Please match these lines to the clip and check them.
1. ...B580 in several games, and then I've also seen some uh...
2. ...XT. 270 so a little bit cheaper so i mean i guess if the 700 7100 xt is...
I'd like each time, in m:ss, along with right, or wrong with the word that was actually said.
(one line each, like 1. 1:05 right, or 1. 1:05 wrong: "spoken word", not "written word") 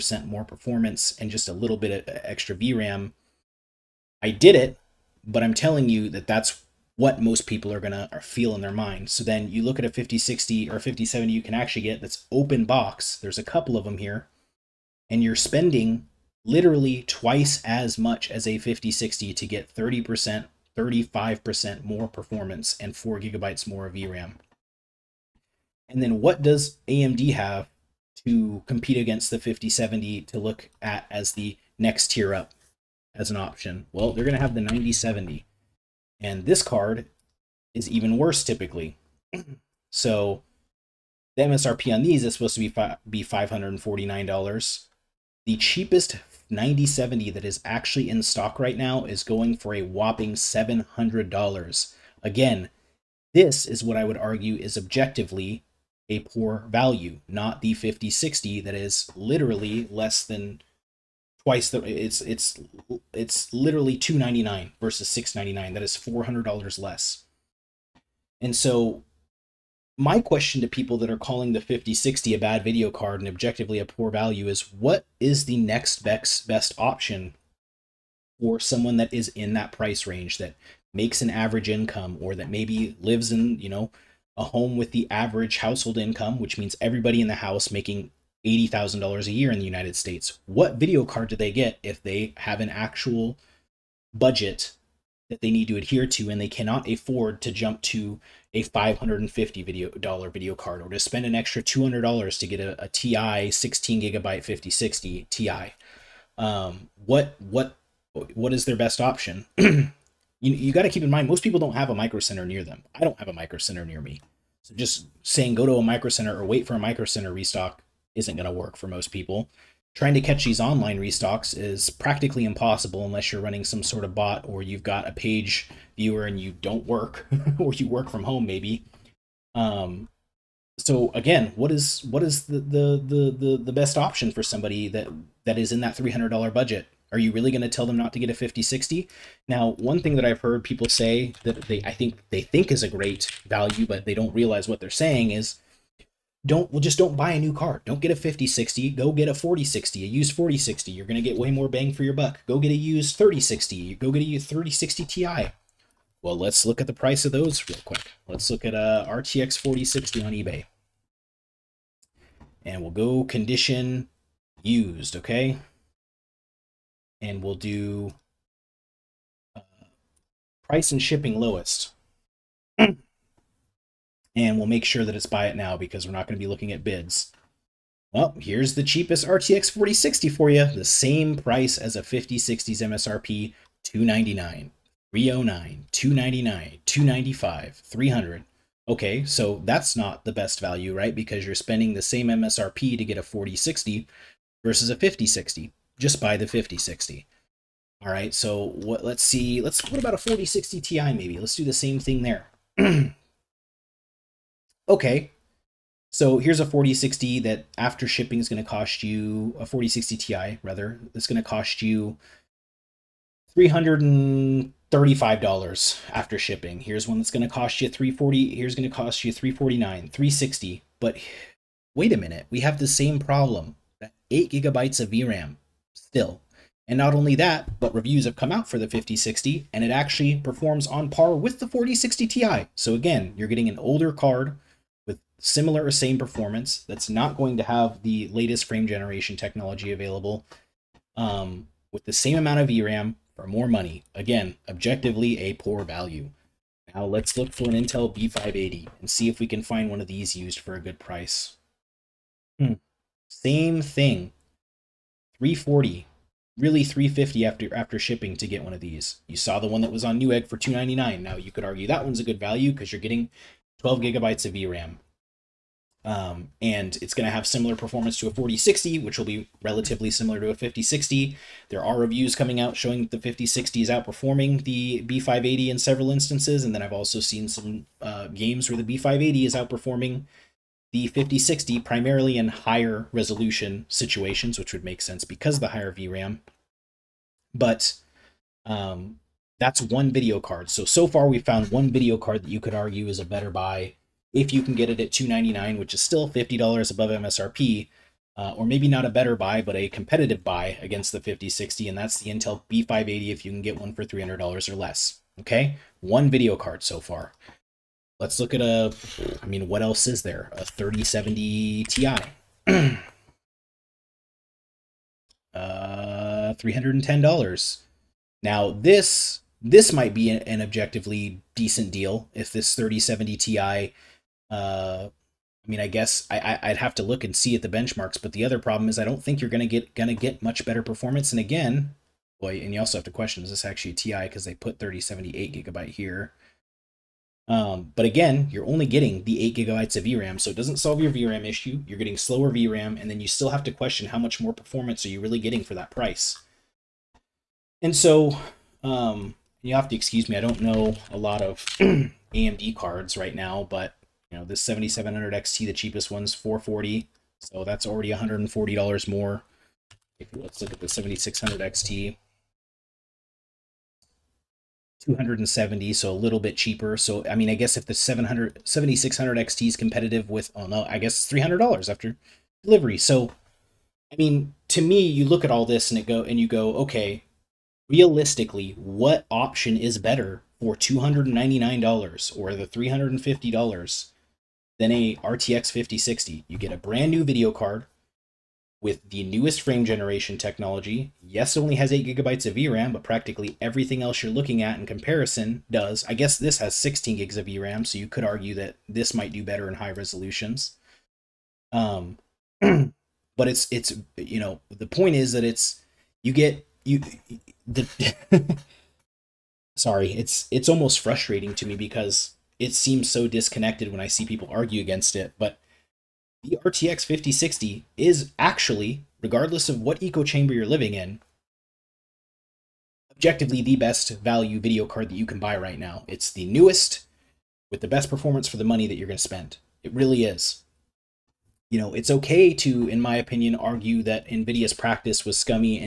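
1. 4:35 wrong: "instances", not "games"
2. 6:01 wrong: "7600", not "7100".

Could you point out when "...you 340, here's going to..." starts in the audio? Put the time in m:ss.
3:37.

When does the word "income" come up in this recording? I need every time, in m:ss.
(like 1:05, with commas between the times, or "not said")
1:21, 1:25.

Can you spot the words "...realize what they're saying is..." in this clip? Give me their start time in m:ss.
2:24.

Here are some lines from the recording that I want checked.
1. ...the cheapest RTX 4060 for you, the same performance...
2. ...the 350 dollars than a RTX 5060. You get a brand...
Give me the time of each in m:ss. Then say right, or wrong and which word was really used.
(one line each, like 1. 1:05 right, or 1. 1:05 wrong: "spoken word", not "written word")
1. 2:58 wrong: "price", not "performance"
2. 6:22 right.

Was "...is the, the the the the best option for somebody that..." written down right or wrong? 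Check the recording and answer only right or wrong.
right.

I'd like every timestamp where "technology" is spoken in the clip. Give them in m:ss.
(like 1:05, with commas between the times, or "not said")
3:59, 6:30.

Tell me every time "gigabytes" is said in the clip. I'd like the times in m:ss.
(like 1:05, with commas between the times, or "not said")
0:23, 1:44, 3:44, 4:24, 5:35, 5:39, 6:32.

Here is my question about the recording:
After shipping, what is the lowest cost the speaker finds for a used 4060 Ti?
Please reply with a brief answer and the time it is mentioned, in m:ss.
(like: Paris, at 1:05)
$335, at 3:33.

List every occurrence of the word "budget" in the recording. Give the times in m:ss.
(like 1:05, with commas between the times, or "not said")
1:34, 2:16.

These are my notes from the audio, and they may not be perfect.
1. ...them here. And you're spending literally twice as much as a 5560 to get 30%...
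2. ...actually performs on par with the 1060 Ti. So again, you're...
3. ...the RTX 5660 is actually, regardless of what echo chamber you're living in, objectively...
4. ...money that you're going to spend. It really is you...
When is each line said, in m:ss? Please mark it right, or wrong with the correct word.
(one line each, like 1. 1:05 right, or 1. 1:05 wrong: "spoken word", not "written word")
1. 0:13 wrong: "5060", not "5560"
2. 3:49 wrong: "4060", not "1060"
3. 6:56 wrong: "5060", not "5660"
4. 7:08 right.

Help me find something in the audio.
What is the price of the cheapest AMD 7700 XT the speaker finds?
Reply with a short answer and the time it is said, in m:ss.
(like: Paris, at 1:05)
$440, at 5:56.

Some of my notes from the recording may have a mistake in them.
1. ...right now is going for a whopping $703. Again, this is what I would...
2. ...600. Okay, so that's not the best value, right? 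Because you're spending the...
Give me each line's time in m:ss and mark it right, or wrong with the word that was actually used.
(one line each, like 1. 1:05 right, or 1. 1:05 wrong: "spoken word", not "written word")
1. 0:48 wrong: "700", not "703"
2. 3:07 wrong: "300", not "600".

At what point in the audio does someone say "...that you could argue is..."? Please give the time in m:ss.
4:52.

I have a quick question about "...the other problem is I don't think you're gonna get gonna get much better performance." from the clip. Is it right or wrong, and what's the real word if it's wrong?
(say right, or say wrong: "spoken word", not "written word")
right.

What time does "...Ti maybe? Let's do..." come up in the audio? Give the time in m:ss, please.
3:20.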